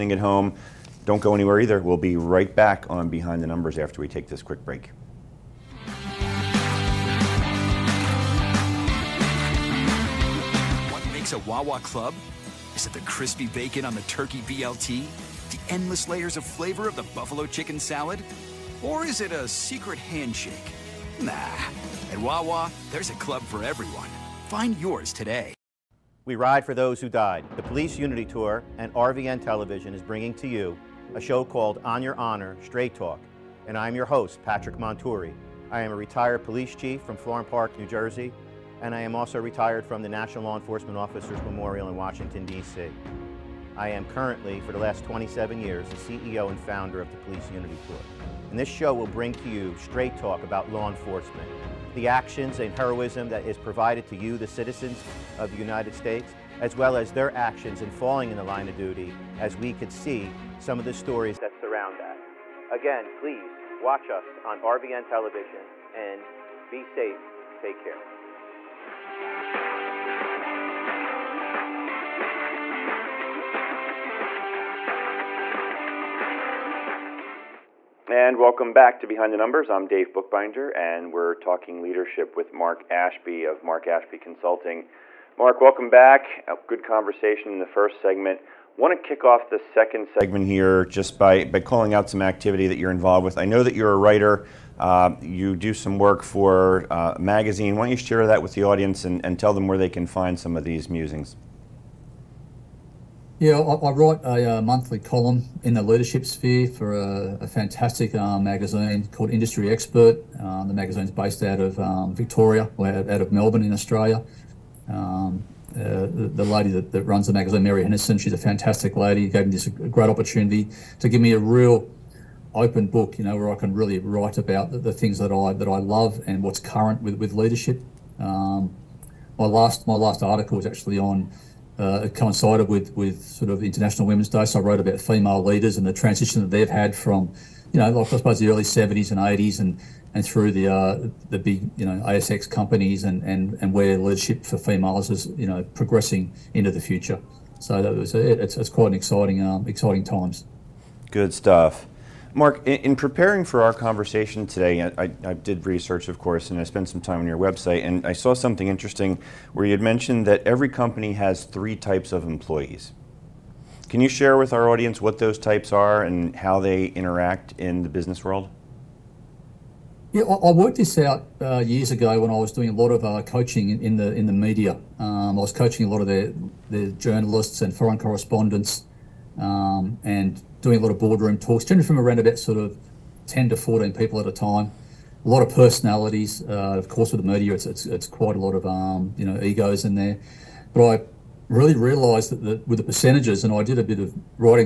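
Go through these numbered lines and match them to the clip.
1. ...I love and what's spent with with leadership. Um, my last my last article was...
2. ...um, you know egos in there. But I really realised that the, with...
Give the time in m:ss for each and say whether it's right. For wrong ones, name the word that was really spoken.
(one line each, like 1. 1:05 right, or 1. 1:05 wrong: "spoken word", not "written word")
1. 2:05 wrong: "current", not "spent"
2. 3:08 right.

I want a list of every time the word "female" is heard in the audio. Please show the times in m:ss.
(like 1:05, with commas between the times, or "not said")
2:14, 2:24.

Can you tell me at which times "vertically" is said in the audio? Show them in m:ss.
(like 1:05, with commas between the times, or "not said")
not said.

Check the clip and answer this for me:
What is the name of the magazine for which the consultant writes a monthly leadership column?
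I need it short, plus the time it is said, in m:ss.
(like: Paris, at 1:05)
Industry Expert, at 1:49.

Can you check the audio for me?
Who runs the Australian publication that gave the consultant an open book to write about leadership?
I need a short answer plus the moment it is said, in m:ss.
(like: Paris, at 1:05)
Mary Henderson, at 1:57.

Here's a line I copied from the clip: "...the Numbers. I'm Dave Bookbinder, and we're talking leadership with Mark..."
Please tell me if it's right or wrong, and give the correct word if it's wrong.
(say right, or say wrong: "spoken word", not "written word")
right.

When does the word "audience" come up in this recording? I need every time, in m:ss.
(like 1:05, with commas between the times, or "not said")
1:38, 2:44.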